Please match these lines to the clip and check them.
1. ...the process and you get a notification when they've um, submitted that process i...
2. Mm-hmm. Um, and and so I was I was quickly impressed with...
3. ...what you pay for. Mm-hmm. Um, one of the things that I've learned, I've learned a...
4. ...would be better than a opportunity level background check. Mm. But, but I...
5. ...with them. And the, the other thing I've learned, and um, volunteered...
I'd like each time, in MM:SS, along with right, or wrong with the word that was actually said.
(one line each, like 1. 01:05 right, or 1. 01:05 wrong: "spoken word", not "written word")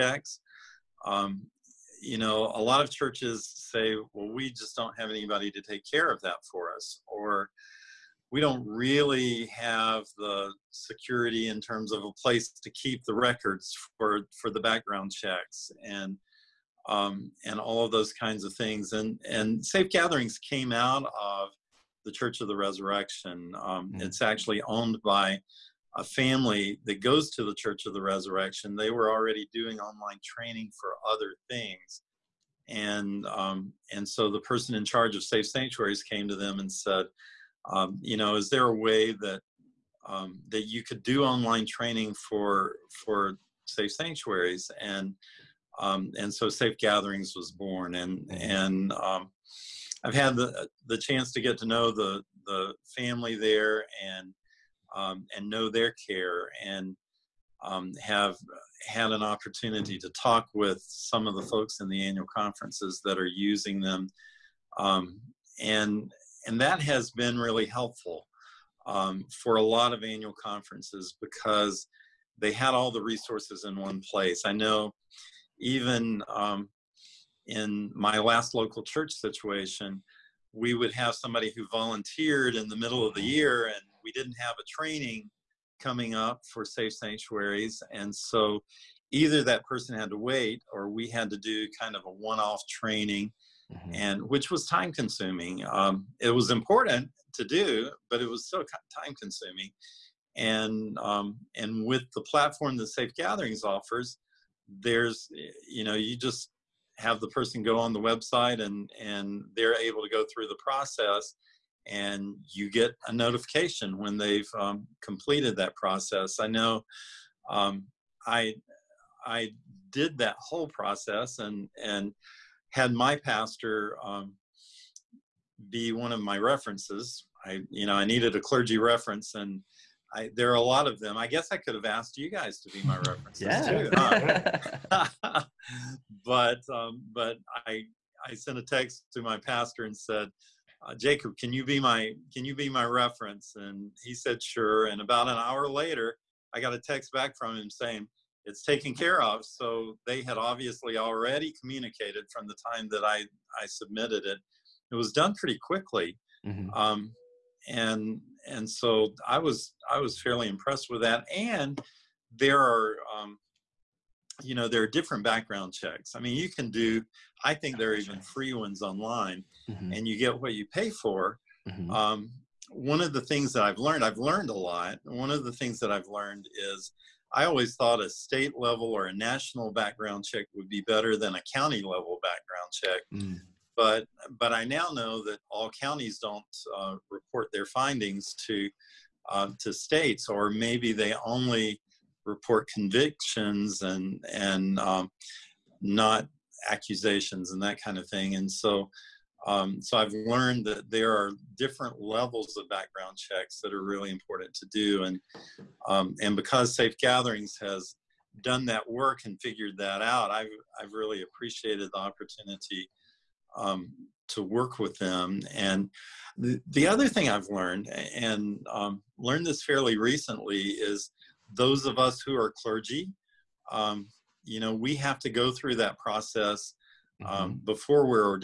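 1. 01:50 wrong: "completed", not "submitted"
2. 02:36 wrong: "fairly", not "quickly"
3. 02:50 right
4. 03:00 wrong: "county", not "opportunity"
5. 03:34 wrong: "learned", not "volunteered".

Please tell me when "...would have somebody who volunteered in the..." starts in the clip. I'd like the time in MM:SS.
01:20.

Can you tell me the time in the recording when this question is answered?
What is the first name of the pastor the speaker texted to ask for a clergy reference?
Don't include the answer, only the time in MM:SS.
02:20.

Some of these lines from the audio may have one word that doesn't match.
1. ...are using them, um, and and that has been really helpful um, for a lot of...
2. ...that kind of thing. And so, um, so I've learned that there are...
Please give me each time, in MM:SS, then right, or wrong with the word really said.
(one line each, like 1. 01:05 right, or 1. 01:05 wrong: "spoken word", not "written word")
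1. 01:03 right
2. 03:17 right.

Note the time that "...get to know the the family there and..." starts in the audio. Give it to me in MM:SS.
00:51.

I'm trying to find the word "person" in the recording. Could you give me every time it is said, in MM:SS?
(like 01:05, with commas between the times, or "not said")
00:34, 01:29, 01:47.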